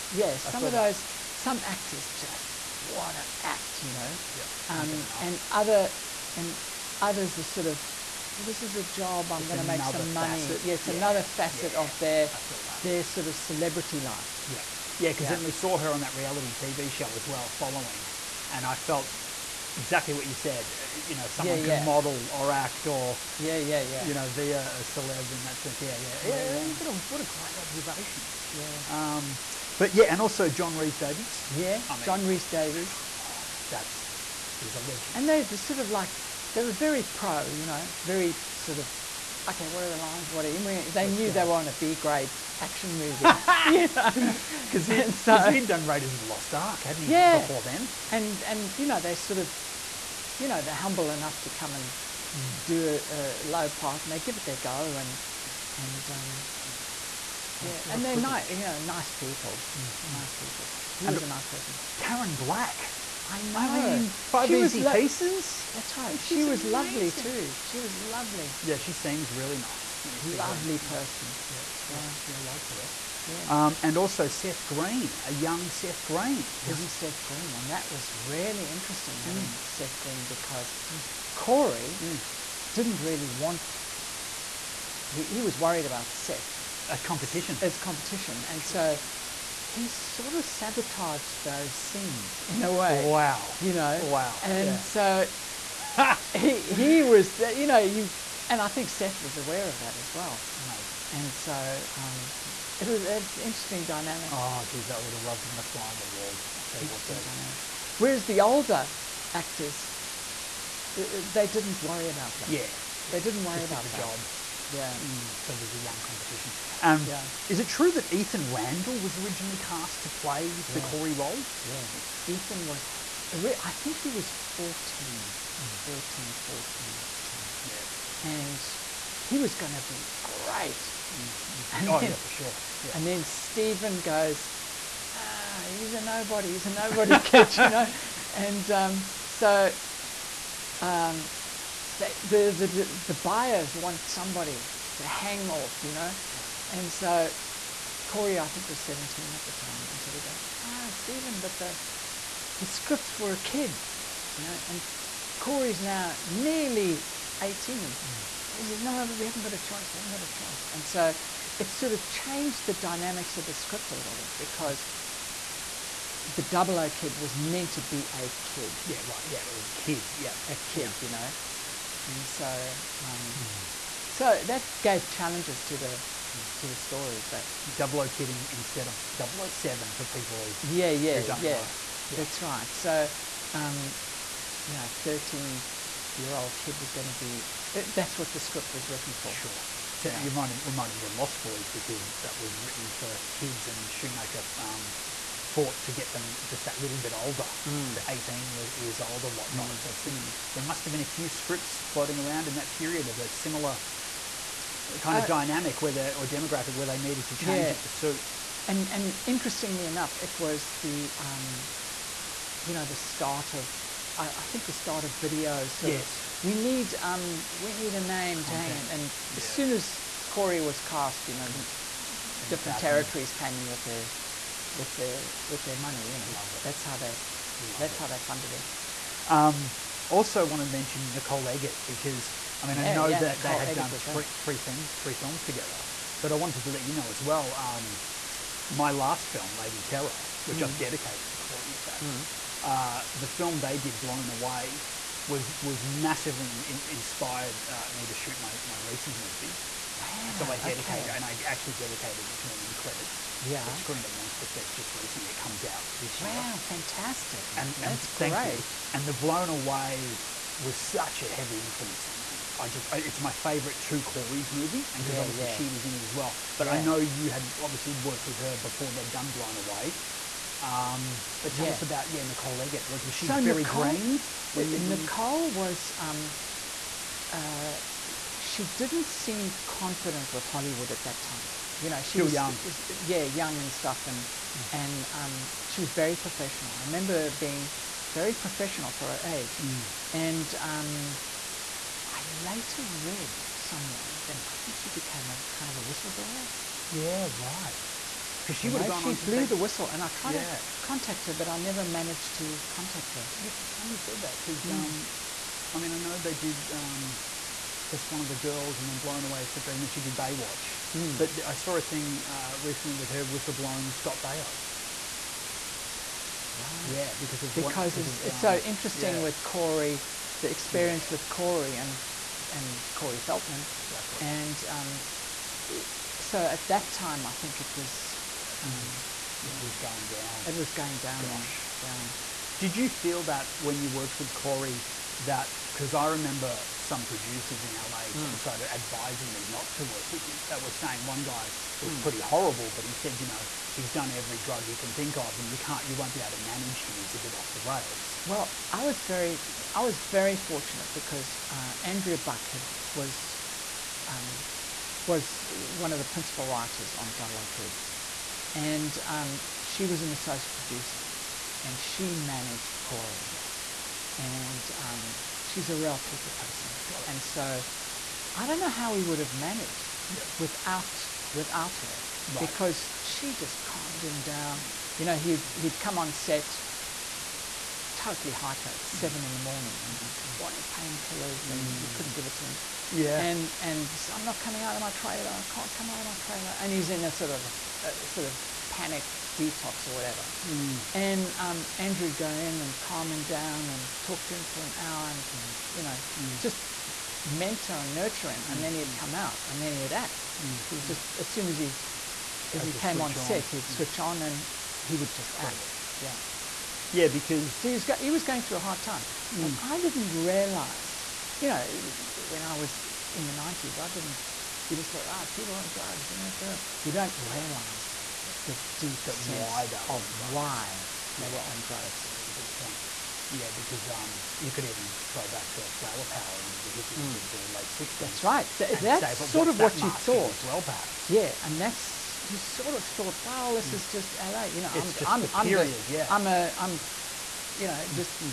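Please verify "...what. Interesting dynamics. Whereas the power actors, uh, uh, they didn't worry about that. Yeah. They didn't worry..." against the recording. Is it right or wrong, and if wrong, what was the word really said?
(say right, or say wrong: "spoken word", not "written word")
wrong: "older", not "power".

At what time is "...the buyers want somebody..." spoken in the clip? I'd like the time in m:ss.
2:23.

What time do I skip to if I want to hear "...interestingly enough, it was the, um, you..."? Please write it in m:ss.
3:29.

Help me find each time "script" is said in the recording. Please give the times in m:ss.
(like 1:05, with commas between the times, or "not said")
2:32, 2:43, 3:08, 3:21.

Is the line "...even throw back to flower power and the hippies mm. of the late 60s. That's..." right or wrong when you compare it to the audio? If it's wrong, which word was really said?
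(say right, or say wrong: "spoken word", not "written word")
right.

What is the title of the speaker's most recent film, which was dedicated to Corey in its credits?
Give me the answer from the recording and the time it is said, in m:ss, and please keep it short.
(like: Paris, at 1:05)
Lady Terror, at 3:59.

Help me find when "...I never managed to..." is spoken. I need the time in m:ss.
5:01.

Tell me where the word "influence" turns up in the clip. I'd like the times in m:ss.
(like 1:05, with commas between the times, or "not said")
4:21.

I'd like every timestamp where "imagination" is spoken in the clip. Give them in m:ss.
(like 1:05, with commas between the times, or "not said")
not said.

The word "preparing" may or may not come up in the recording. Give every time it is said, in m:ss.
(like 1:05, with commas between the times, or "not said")
not said.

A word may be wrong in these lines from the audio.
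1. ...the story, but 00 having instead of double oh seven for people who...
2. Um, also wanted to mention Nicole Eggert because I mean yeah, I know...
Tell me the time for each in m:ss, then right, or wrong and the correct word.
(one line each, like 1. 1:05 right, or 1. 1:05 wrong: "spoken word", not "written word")
1. 2:56 wrong: "kidding", not "having"
2. 3:49 right.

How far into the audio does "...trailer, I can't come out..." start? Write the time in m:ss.
6:24.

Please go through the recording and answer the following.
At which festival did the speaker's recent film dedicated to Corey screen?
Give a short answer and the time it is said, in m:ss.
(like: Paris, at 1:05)
Monster Fest, at 4:14.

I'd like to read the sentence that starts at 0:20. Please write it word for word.
Uh, you know, someone yeah, could model or act or yeah, yeah, yeah.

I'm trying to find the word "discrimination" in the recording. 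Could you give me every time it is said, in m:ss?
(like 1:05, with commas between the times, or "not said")
not said.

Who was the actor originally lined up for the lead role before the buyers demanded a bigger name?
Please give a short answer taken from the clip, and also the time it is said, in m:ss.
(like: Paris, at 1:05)
Ethan Randall, at 1:58.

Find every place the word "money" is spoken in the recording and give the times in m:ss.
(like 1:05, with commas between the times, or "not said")
0:10, 3:45.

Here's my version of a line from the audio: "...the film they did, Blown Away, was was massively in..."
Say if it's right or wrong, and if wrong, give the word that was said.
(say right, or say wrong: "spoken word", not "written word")
right.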